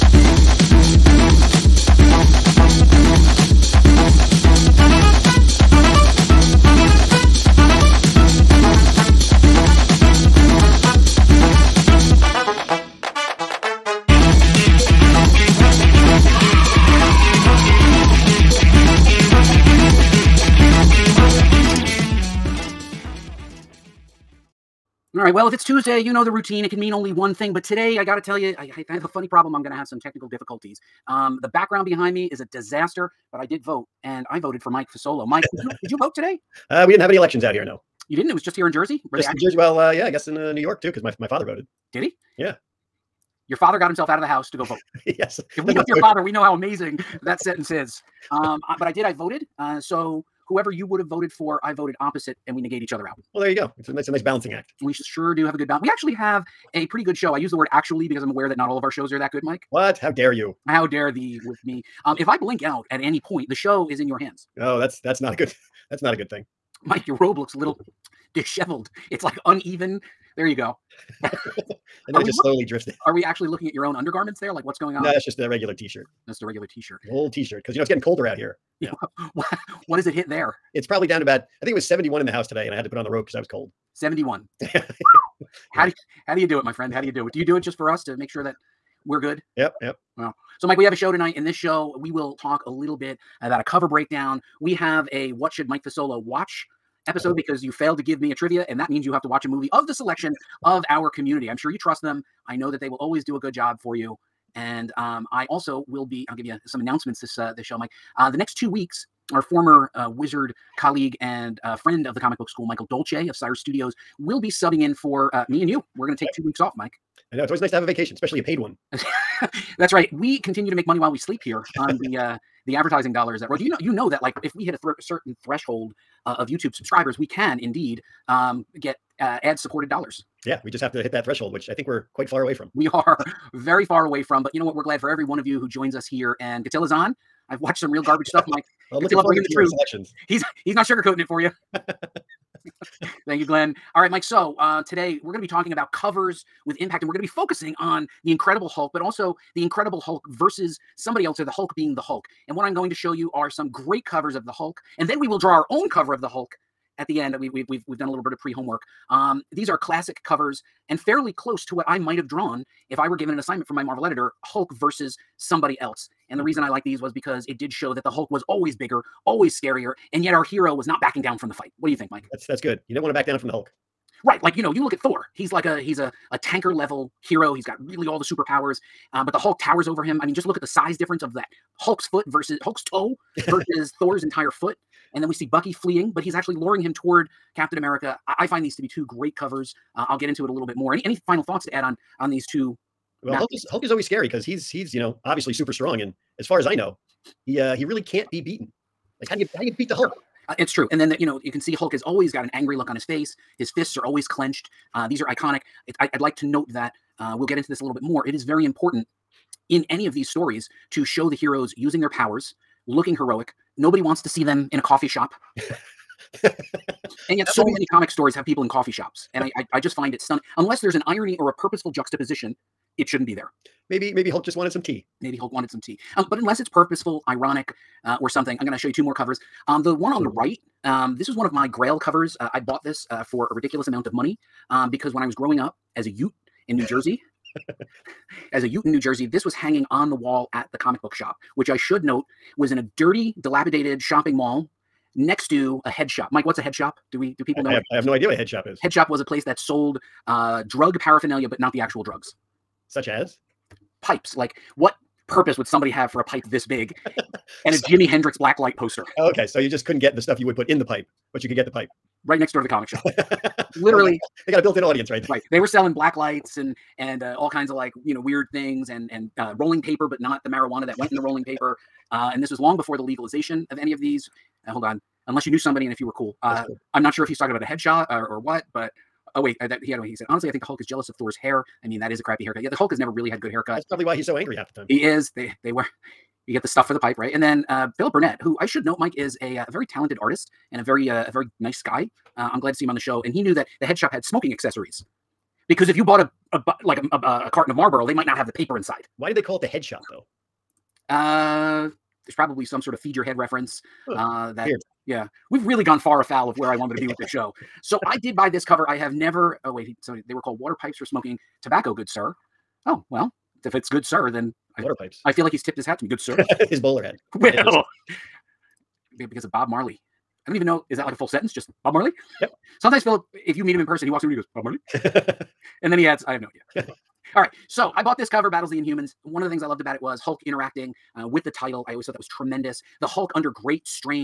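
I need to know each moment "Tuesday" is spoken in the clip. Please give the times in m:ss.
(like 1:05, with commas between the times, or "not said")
0:25.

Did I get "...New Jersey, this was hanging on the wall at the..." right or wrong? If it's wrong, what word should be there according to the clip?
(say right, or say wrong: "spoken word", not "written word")
right.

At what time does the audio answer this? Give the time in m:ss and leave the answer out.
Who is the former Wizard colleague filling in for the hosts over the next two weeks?
1:52.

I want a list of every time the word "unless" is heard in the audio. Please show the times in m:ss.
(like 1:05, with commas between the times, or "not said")
3:40, 3:46, 4:35.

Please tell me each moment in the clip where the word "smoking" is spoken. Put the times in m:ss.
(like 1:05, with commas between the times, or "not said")
4:54, 5:11.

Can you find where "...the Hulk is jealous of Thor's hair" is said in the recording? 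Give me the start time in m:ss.
4:40.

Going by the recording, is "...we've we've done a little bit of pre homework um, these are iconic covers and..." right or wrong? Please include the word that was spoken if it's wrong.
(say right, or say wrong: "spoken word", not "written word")
wrong: "classic", not "iconic".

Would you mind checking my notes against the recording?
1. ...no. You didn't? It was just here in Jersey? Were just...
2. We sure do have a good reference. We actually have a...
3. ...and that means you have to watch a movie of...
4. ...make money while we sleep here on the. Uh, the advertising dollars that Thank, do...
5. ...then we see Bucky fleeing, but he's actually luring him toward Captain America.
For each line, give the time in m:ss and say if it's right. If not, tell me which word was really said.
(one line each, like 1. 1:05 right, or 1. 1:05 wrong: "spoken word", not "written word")
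1. 0:37 right
2. 0:54 wrong: "balance", not "reference"
3. 1:38 right
4. 2:00 wrong: "Roy", not "Thank"
5. 3:05 right.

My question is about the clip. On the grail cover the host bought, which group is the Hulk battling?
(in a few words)
the Inhumans.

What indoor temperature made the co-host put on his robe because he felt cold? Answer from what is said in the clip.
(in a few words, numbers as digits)
71.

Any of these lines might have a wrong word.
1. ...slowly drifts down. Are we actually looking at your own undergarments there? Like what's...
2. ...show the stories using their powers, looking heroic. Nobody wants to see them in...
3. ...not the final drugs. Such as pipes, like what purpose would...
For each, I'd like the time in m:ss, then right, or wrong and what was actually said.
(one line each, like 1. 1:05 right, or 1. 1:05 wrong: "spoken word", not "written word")
1. 1:12 right
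2. 3:31 wrong: "heroes", not "stories"
3. 4:11 wrong: "actual", not "final".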